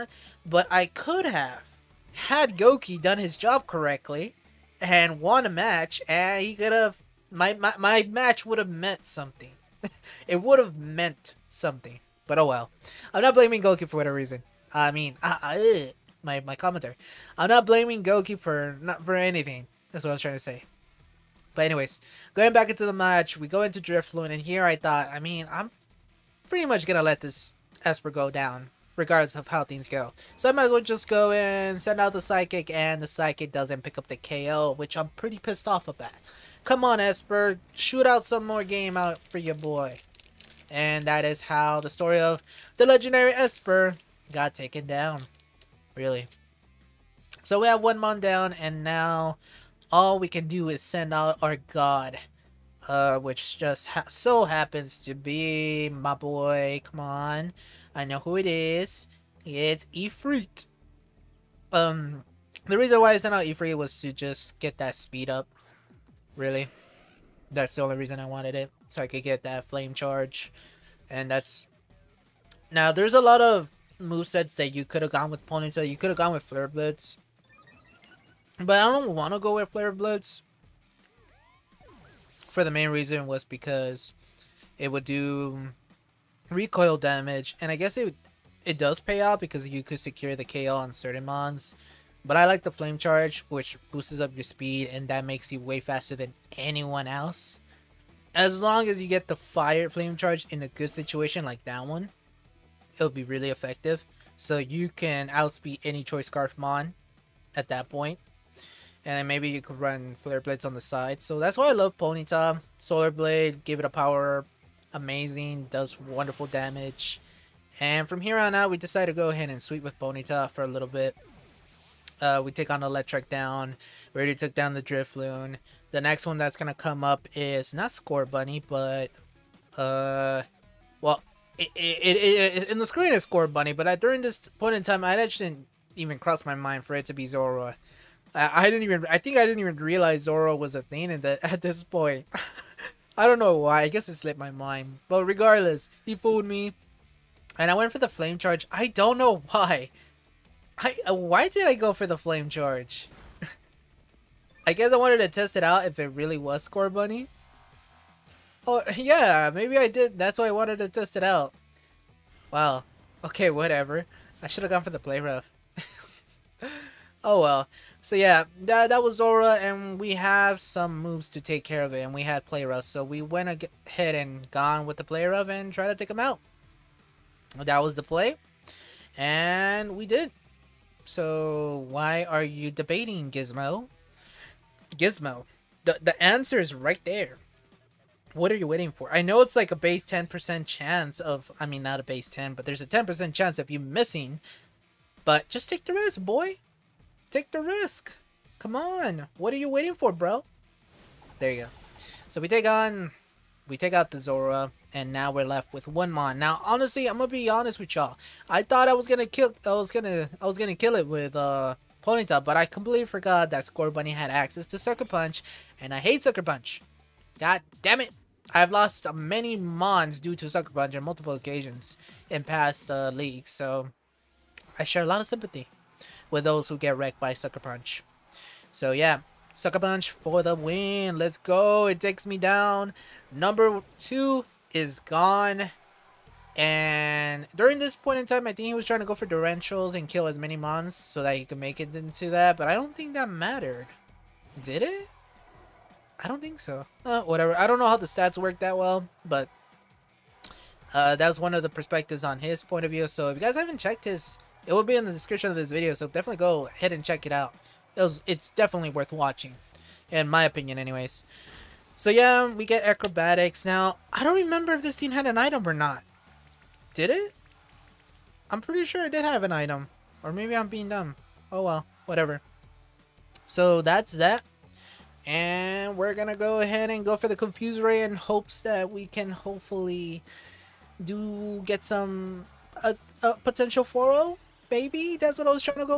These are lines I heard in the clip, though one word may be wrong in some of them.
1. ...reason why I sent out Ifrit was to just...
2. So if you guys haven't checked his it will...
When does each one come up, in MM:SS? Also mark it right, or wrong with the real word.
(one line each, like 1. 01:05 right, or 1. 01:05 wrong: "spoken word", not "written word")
1. 01:02 right
2. 04:13 right.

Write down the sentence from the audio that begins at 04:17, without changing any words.
It was, it's definitely worth watching, in my opinion anyways.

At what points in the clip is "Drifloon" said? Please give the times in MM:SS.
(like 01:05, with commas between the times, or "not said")
00:23, 02:04.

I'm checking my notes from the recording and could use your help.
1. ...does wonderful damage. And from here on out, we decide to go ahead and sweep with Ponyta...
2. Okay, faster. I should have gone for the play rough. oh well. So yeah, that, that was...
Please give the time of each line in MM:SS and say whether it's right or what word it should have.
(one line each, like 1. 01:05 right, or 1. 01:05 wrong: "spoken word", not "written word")
1. 01:55 right
2. 02:43 wrong: "whatever", not "faster".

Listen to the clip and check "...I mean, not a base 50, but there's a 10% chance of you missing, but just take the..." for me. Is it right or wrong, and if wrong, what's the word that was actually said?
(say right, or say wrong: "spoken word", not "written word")
wrong: "10", not "50".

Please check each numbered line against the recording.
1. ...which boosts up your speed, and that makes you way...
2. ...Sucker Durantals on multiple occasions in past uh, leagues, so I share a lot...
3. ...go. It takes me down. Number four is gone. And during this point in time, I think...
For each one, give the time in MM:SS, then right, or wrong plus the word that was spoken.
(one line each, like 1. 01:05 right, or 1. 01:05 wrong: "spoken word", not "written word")
1. 01:33 right
2. 03:40 wrong: "Punch", not "Durantals"
3. 03:51 wrong: "two", not "four".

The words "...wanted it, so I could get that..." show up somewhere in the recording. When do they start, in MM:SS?
01:08.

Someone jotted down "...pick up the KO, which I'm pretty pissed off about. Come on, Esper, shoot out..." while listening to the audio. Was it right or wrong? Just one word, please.
right.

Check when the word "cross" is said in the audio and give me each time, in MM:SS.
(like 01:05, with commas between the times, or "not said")
02:16.